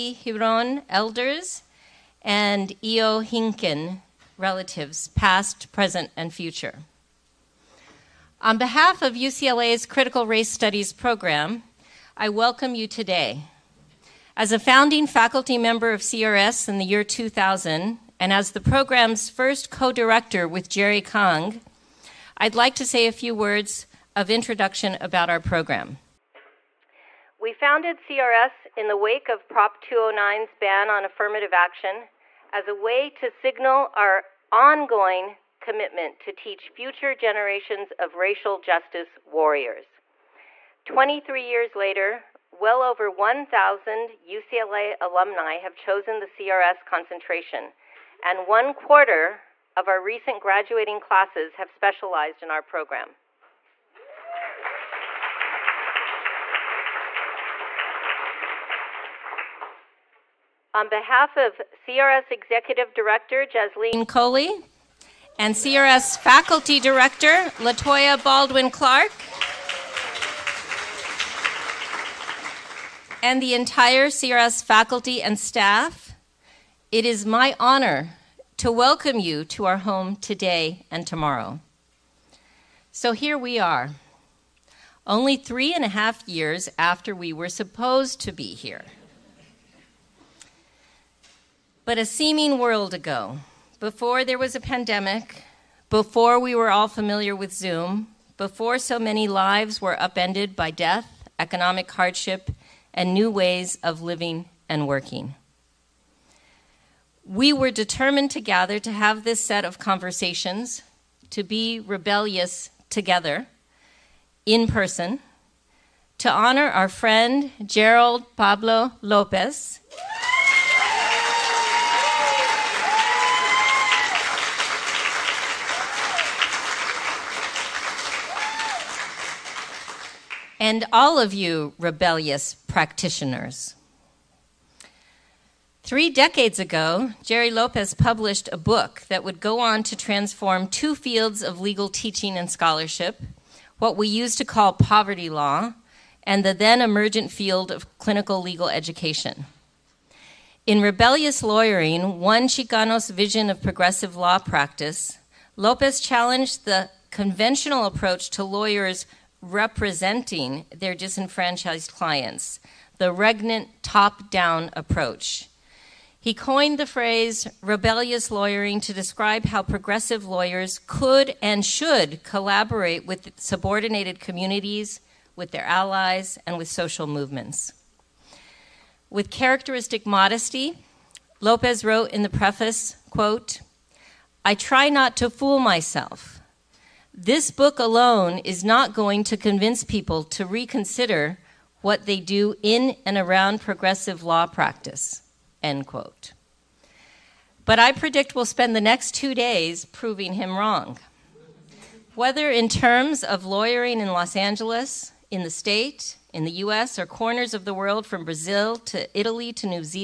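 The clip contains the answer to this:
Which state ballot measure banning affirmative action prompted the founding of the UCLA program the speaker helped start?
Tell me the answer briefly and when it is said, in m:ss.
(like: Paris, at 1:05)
Prop 209, at 0:29.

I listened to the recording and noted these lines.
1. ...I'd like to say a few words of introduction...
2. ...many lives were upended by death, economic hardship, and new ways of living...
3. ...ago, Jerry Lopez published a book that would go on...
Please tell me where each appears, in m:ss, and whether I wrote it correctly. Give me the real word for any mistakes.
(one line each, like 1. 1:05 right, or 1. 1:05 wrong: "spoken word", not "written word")
1. 0:22 right
2. 1:38 right
3. 2:16 right.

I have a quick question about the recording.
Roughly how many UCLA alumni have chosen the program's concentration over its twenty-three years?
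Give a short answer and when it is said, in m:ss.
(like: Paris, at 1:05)
over 1,000, at 0:42.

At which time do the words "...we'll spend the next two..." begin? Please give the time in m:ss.
3:18.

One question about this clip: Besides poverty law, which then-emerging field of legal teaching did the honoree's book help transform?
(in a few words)
clinical legal education.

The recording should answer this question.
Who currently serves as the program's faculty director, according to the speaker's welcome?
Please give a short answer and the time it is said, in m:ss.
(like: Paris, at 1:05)
Latoya Baldwin Clark, at 1:07.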